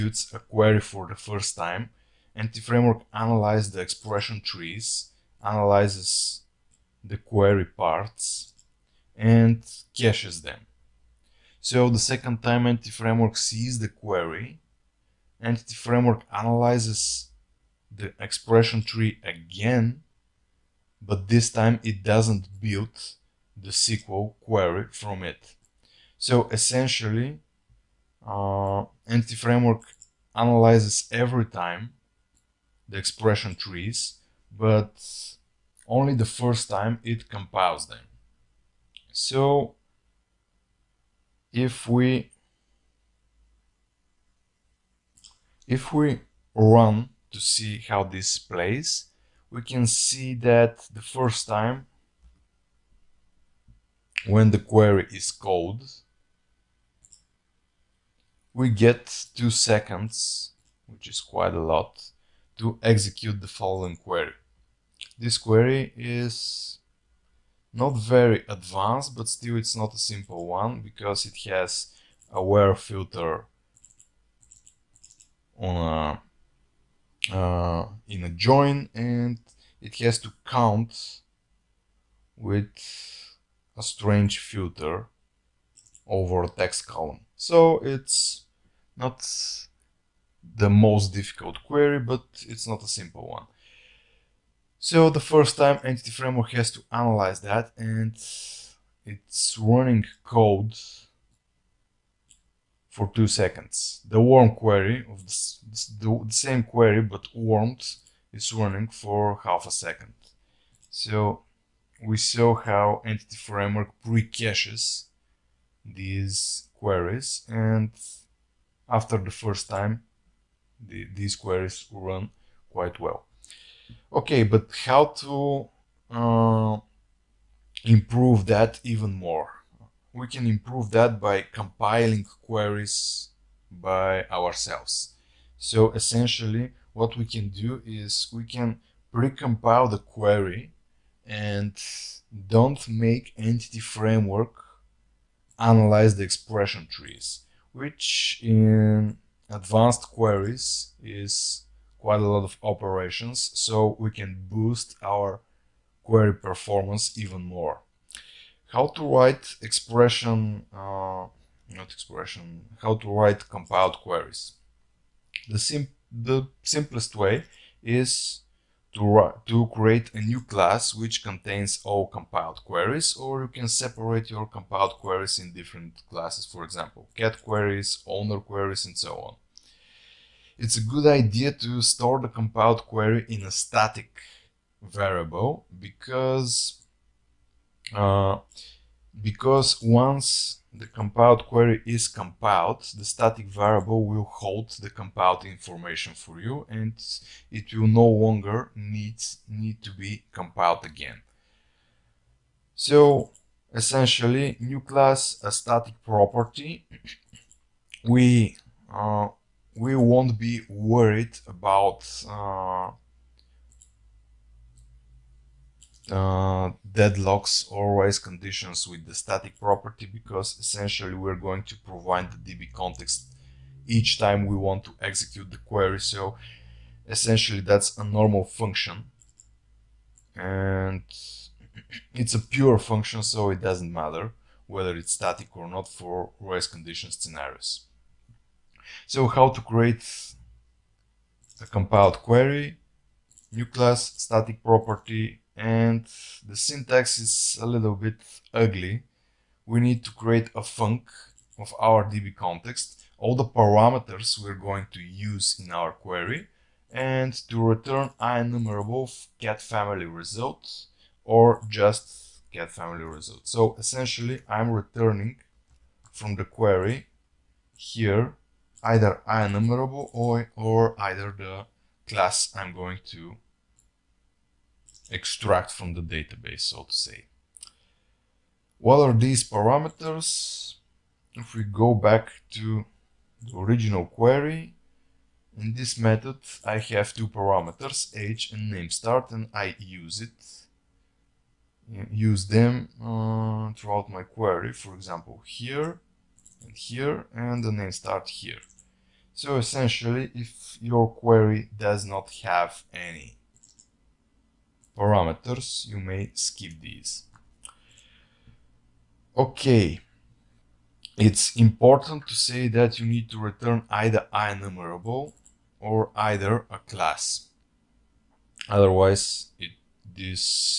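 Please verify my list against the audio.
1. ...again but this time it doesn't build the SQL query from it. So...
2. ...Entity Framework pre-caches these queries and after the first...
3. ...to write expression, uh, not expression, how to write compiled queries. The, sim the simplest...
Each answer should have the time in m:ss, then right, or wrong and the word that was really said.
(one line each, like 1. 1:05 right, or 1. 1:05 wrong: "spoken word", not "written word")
1. 0:19 right
2. 1:53 right
3. 2:38 right.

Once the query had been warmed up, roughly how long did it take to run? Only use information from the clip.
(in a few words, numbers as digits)
half a second.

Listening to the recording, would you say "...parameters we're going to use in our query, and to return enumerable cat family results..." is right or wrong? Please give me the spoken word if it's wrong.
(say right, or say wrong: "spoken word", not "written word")
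right.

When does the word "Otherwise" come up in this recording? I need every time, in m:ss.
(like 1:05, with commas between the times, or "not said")
5:18.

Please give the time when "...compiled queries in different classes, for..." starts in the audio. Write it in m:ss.
2:54.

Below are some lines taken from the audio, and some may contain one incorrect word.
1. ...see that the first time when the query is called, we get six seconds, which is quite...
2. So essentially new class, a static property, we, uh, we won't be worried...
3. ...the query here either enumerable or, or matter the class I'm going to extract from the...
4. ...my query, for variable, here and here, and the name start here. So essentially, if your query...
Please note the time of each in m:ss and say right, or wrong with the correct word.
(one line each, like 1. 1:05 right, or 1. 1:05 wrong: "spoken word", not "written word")
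1. 0:49 wrong: "two", not "six"
2. 3:22 right
3. 4:26 wrong: "either", not "matter"
4. 4:54 wrong: "example", not "variable".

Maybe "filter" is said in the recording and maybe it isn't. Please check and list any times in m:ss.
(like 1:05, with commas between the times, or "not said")
1:12, 1:24.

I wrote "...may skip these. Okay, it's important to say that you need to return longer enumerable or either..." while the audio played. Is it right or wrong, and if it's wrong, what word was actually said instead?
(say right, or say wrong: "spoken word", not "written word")
wrong: "either", not "longer".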